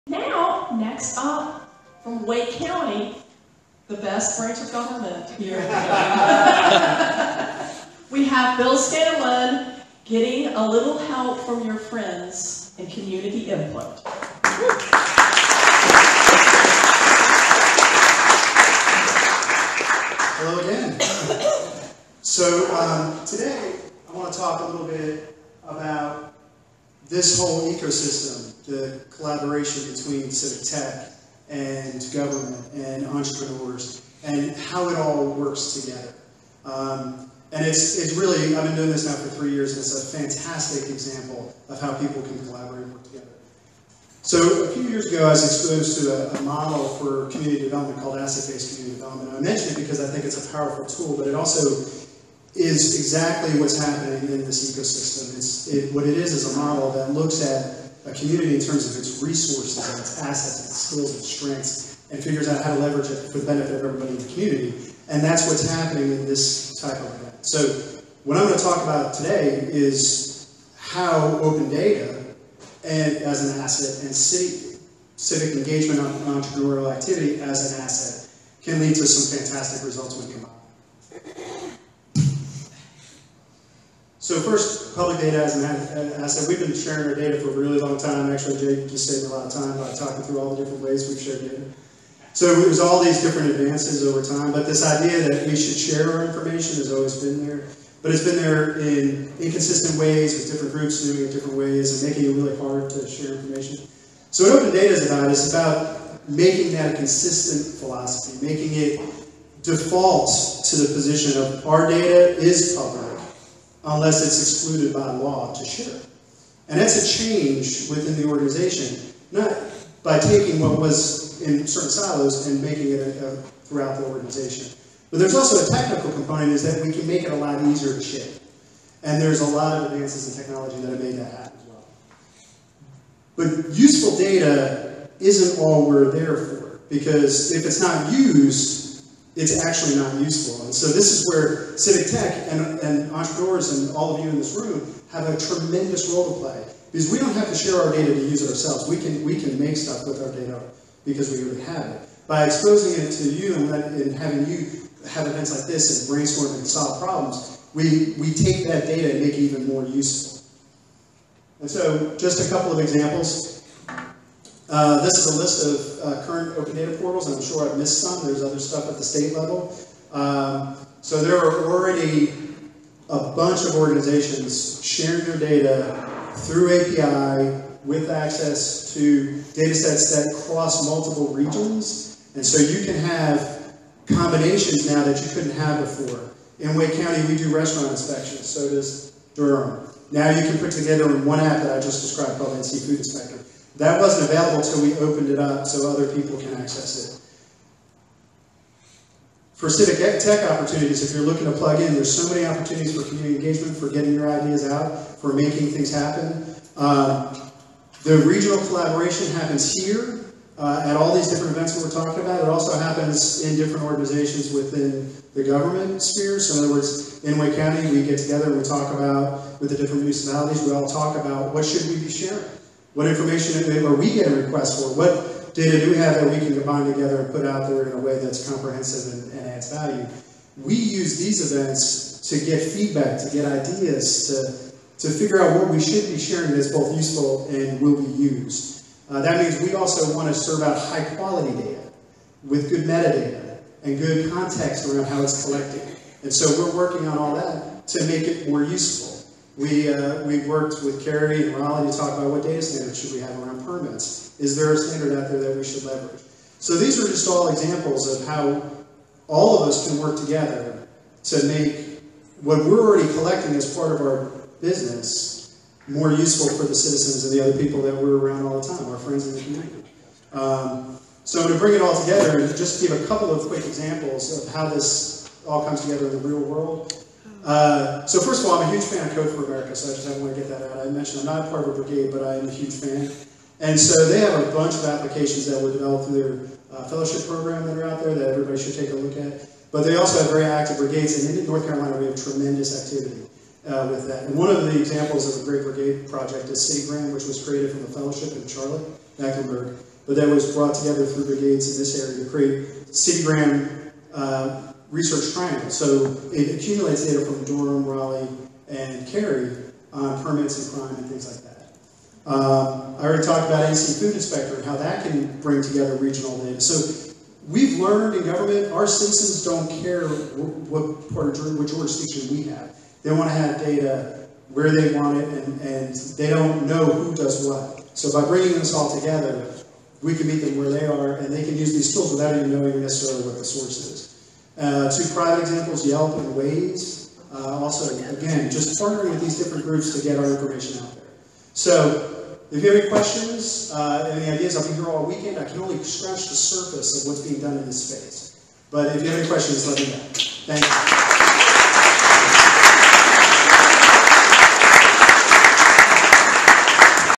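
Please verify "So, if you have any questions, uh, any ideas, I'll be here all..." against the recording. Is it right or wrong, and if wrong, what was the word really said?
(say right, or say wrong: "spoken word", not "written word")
right.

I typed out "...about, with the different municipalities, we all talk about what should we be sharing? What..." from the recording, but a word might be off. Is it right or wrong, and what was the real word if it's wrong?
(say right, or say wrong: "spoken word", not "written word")
right.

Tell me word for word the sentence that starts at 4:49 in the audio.
But they also have very active brigades, and in North Carolina we have tremendous activity uh, with that.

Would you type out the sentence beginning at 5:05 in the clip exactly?
So it accumulates data from Durham, Raleigh, and Cary on permits and crime and things like that.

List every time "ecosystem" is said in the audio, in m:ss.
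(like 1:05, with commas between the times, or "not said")
0:27, 0:54.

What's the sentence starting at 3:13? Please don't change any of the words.
That wasn't available until we opened it up so other people can access it.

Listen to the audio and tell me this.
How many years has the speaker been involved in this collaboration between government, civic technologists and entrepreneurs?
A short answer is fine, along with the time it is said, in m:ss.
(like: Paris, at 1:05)
3, at 0:39.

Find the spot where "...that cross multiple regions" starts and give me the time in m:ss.
3:00.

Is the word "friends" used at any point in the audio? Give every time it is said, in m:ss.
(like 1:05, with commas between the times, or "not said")
0:11, 4:28.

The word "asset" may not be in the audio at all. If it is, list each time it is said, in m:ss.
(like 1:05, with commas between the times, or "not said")
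0:48, 1:00, 1:13, 1:17, 1:26.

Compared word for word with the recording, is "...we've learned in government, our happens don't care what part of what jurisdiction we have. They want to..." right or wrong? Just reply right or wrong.
wrong.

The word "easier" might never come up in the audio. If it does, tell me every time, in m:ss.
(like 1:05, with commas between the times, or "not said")
2:07.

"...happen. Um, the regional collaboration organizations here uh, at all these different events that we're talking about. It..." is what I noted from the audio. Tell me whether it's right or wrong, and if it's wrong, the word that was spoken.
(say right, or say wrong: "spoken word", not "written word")
wrong: "happens", not "organizations".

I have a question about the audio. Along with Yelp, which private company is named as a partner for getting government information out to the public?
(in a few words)
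Waze.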